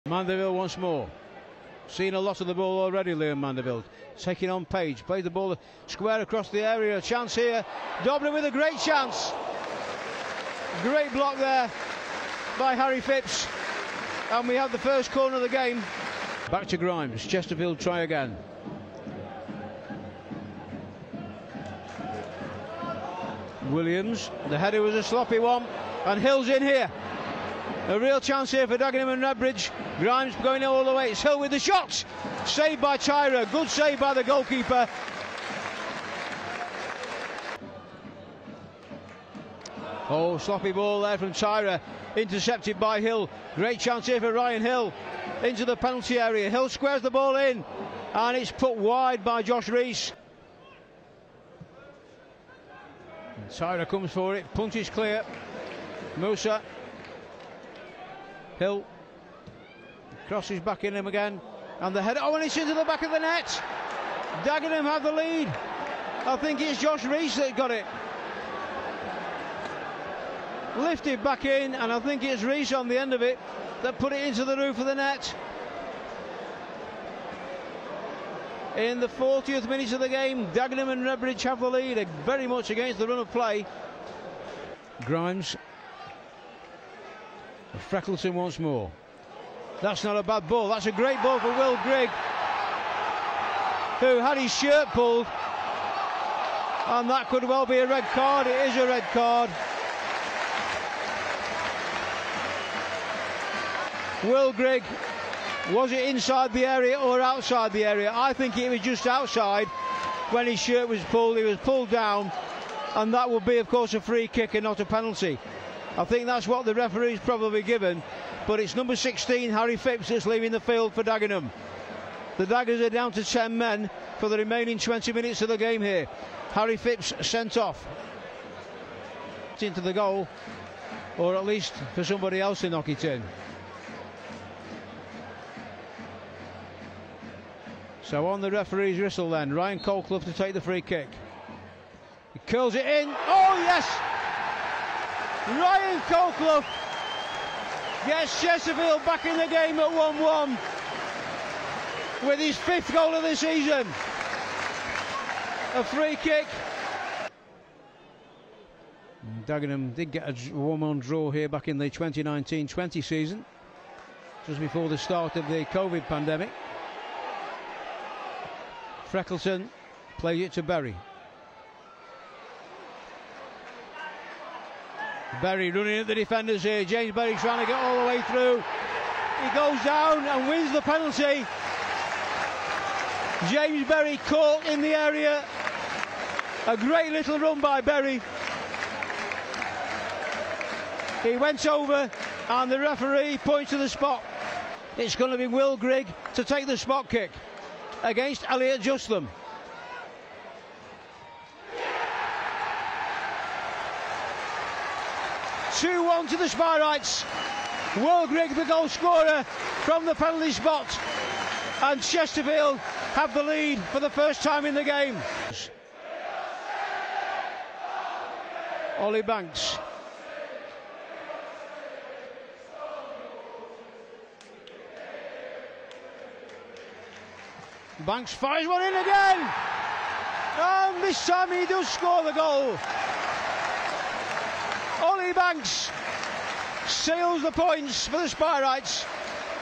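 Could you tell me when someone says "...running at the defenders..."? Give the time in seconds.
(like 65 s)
175 s.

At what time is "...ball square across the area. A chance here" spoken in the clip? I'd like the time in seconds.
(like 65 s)
5 s.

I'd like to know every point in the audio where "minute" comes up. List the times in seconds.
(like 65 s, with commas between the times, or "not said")
79 s, 125 s.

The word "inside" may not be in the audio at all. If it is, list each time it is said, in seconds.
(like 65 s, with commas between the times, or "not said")
106 s.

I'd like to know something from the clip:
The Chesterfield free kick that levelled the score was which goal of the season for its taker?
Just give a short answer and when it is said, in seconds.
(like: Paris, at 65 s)
fifth, at 152 s.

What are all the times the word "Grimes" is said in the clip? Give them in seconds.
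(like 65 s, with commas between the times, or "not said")
16 s, 29 s, 85 s.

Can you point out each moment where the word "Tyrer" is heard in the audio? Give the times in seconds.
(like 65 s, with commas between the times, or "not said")
32 s, 41 s, 53 s.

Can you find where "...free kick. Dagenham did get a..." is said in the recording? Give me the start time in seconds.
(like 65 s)
155 s.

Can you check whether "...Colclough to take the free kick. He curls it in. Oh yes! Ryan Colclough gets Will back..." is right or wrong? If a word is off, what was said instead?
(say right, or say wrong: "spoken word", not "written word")
wrong: "Chesterfield", not "Will".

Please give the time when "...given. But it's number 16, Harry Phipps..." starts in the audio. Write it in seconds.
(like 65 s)
117 s.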